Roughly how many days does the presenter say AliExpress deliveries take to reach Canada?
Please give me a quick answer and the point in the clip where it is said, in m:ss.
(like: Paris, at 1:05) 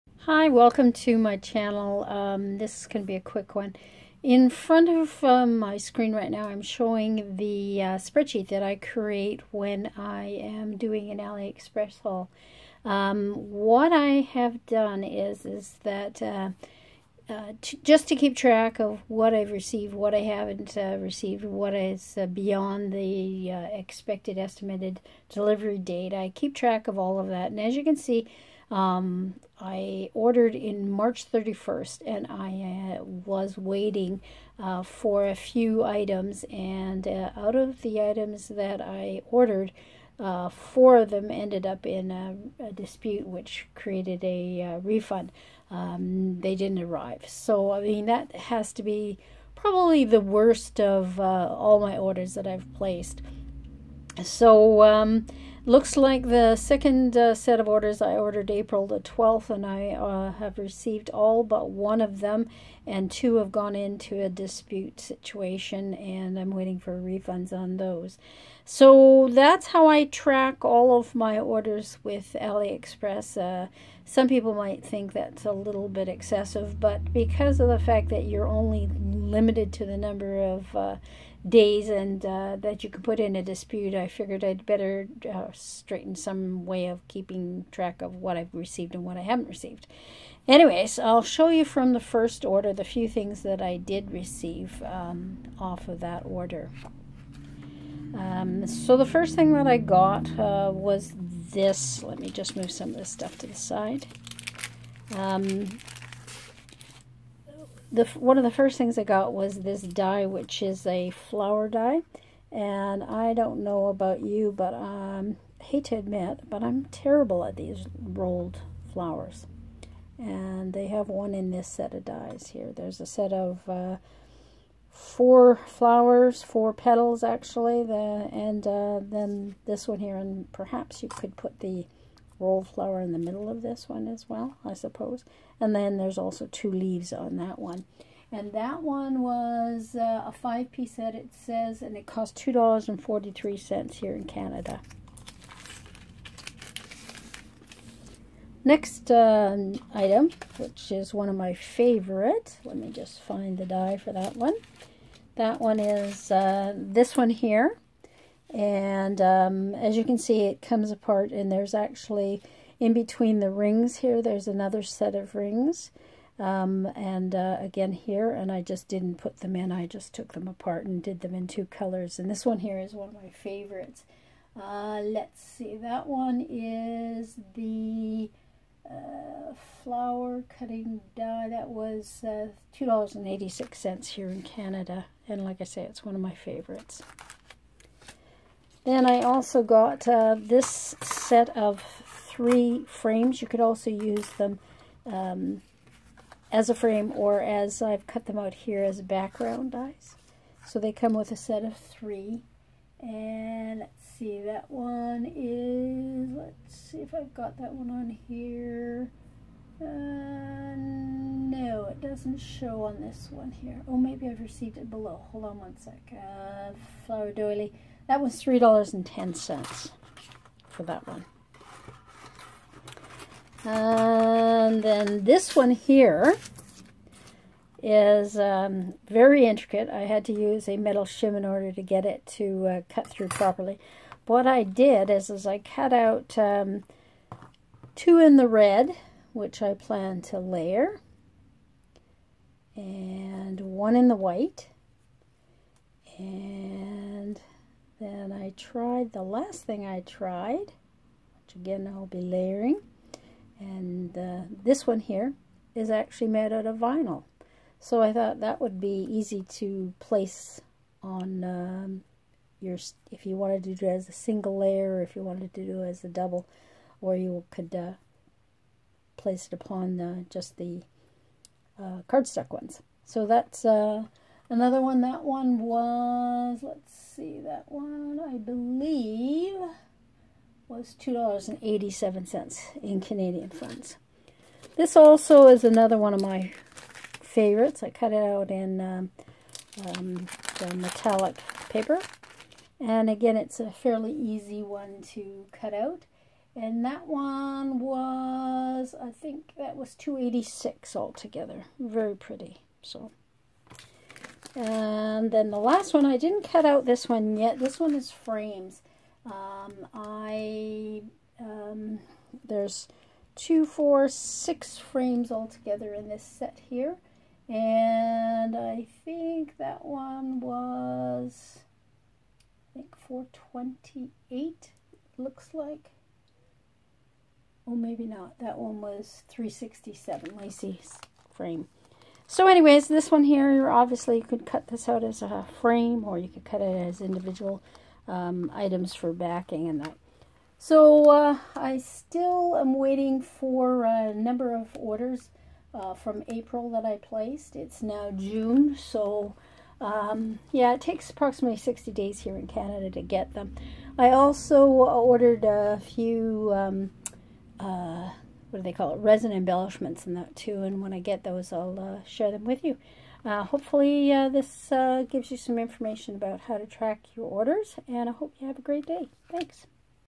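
60 days, at 5:51.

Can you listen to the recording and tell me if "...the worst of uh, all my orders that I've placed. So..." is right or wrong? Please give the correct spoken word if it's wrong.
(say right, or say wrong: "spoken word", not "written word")
right.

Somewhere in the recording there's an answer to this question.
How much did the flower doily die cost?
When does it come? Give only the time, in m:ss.
3:38.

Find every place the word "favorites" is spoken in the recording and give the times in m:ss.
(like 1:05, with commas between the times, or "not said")
2:31, 2:53, 3:06, 4:47.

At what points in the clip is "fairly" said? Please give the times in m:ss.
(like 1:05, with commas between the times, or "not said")
4:53.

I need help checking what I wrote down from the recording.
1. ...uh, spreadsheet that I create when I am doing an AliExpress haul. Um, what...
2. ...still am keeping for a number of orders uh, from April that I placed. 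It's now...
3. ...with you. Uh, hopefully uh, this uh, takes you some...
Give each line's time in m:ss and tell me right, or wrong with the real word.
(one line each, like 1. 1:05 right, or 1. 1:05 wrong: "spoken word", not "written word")
1. 0:07 right
2. 5:41 wrong: "waiting", not "keeping"
3. 6:02 wrong: "gives", not "takes".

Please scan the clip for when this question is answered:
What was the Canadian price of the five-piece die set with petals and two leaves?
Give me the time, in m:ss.
2:22.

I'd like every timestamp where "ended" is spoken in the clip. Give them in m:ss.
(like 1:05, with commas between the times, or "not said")
0:41.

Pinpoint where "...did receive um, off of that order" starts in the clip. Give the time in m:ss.
1:33.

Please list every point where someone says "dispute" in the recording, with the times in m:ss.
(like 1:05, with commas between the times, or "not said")
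0:42, 1:04, 1:23.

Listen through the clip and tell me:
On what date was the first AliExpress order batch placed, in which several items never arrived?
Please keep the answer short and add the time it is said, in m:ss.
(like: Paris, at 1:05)
March 31st, at 0:30.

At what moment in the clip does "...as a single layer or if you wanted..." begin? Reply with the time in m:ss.
4:23.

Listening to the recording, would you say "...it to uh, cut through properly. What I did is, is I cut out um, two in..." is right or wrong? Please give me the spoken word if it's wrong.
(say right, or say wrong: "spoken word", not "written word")
right.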